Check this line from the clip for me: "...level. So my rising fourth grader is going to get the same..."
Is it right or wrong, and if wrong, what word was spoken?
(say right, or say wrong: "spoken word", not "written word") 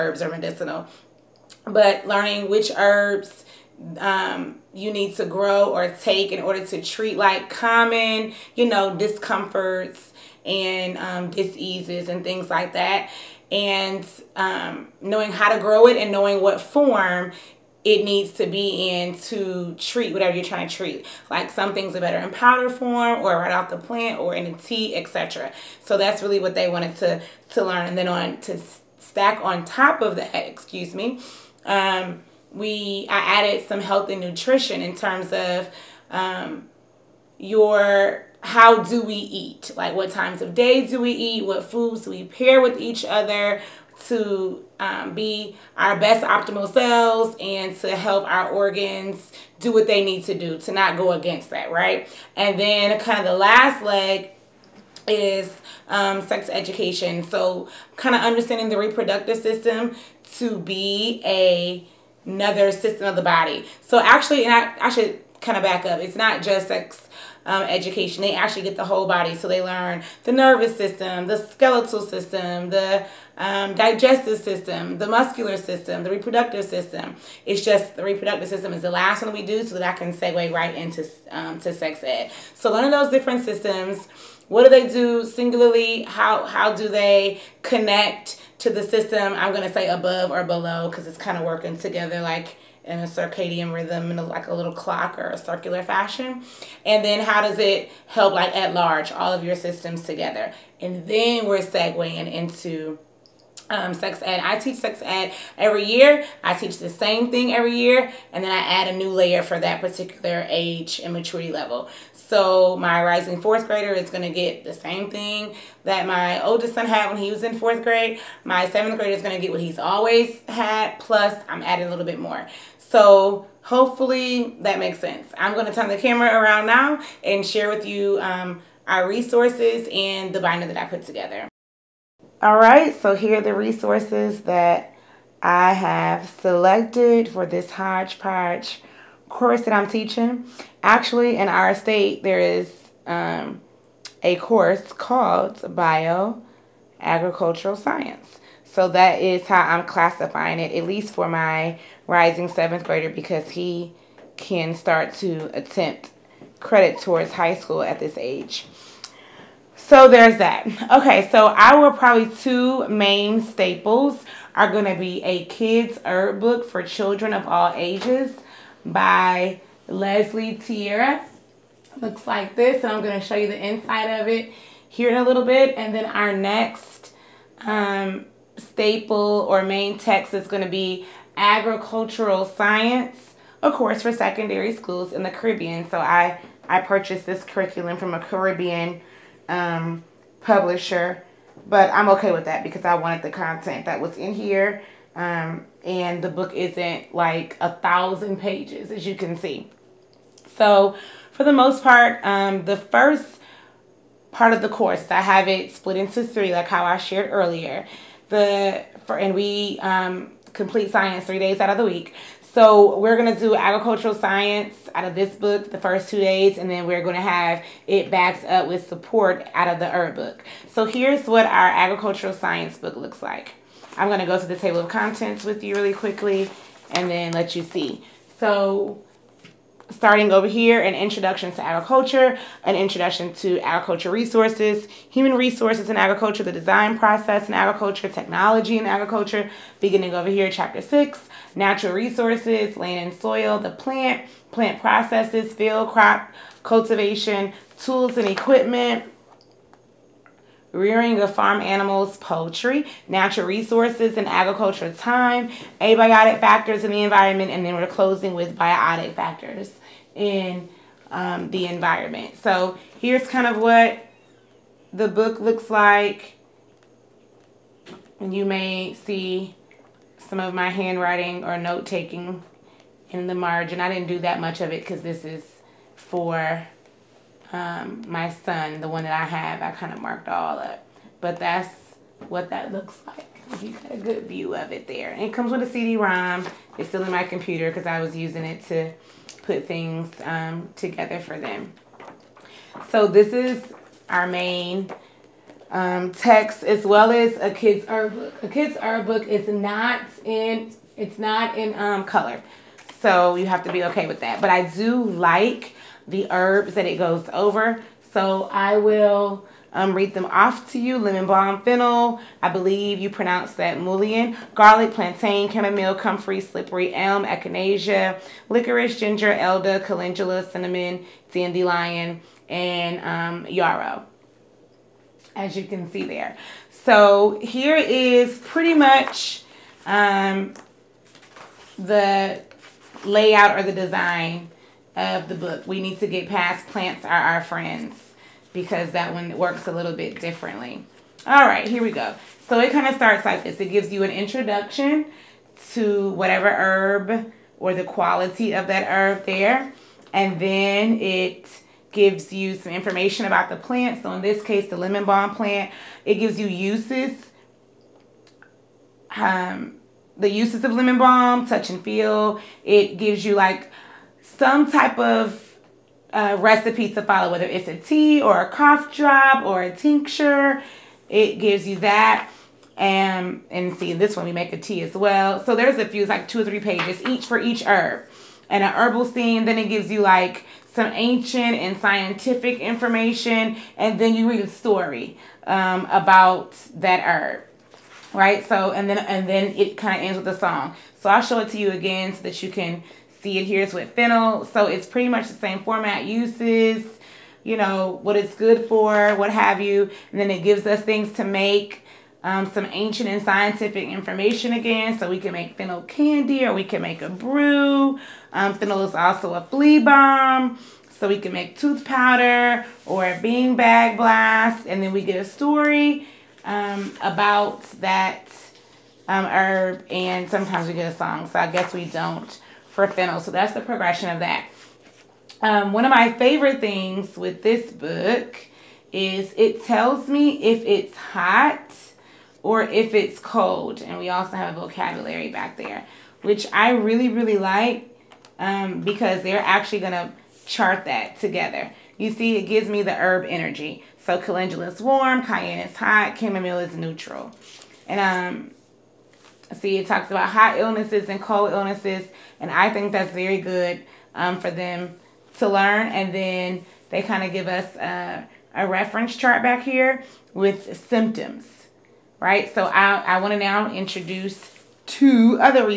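right.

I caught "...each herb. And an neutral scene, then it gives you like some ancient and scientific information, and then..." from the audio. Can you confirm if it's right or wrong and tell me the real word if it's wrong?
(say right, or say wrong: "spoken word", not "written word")
wrong: "herbal", not "neutral".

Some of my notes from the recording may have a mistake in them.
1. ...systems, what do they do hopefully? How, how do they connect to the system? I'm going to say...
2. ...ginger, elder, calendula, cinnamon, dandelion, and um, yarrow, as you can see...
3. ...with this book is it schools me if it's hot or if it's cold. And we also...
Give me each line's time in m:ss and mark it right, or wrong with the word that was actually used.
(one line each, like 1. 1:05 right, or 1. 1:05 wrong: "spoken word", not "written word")
1. 1:23 wrong: "singularly", not "hopefully"
2. 5:18 right
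3. 7:07 wrong: "tells", not "schools".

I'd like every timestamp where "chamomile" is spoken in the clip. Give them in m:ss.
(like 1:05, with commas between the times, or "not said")
5:15, 7:26.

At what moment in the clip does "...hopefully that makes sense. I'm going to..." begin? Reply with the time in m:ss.
2:03.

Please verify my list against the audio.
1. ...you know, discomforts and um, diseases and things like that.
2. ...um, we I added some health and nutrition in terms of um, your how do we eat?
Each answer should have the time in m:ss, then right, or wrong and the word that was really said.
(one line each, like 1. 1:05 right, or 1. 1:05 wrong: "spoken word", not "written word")
1. 0:08 right
2. 0:31 right.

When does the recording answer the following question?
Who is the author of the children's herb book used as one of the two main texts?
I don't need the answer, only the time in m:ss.
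2:49.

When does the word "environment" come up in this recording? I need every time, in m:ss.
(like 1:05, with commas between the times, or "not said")
4:17, 4:21.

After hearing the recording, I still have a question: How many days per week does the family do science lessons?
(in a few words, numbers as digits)
3.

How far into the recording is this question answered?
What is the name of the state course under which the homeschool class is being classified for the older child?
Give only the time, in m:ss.
2:25.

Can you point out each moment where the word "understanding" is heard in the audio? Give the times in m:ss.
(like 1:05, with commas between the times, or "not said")
0:58.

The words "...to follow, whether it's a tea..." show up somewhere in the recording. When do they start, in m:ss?
6:06.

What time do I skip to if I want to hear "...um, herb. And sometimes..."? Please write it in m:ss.
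6:59.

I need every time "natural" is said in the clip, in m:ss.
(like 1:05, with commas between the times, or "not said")
4:01, 4:13.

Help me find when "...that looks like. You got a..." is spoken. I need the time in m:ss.
4:42.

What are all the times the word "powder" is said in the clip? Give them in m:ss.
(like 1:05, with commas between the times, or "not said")
0:22, 6:51.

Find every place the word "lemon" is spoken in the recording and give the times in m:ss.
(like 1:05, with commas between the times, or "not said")
5:10, 5:54, 6:00.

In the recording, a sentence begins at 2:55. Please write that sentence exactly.
And then our next um, staple or main text is gonna be agricultural science, a course, for secondary schools in the Caribbean.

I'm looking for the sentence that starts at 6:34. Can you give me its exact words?
So it's pretty much the same format, uses, you know, what it's good for, what have you.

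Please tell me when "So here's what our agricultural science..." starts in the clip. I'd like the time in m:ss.
3:40.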